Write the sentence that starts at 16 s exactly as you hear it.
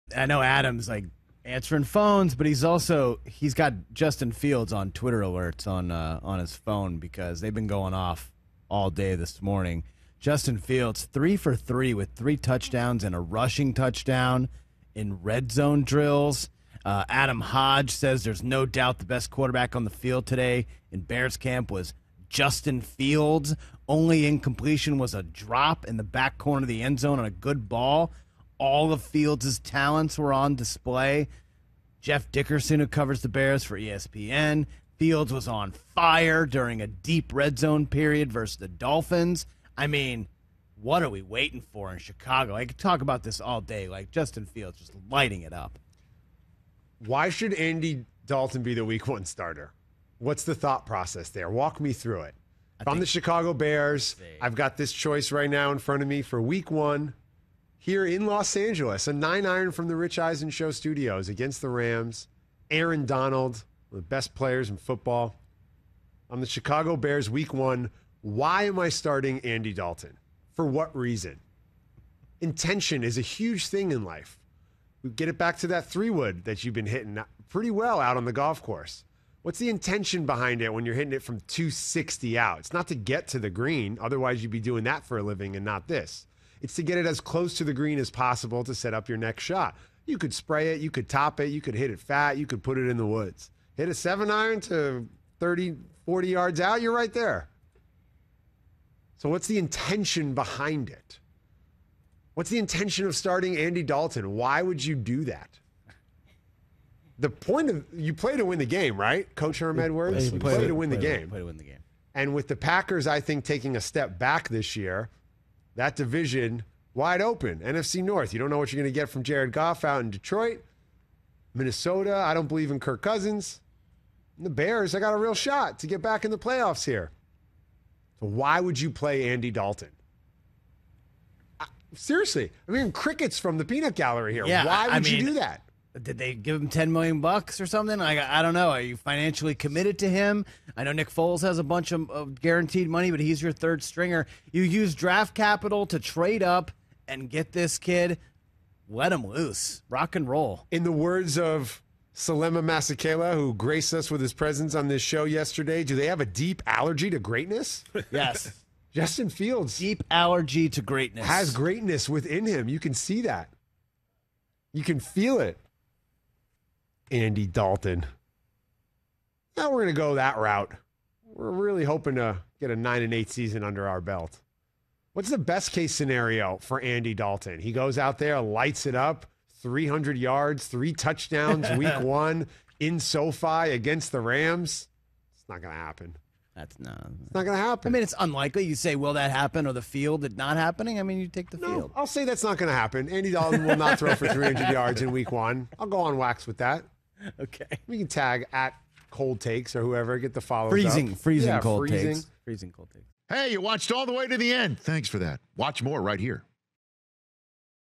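Uh, Adam Hodge says there's no doubt the best quarterback on the field today in Bears camp was Justin Fields.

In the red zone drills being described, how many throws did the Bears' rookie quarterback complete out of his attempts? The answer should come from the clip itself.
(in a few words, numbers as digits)
3 for 3.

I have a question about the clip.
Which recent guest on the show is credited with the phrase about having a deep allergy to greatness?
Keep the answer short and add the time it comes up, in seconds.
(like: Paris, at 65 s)
Selema Masekela, at 152 s.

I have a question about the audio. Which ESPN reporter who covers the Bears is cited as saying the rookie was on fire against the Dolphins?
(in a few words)
Jeff Dickerson.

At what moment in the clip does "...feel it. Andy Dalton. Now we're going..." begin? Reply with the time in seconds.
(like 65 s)
164 s.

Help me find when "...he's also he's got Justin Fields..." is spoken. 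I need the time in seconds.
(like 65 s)
2 s.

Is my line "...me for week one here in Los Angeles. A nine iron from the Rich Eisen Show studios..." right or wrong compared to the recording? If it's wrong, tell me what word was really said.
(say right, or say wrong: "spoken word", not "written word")
right.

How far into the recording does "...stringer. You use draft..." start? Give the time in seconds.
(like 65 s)
143 s.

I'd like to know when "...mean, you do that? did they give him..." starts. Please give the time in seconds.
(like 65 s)
134 s.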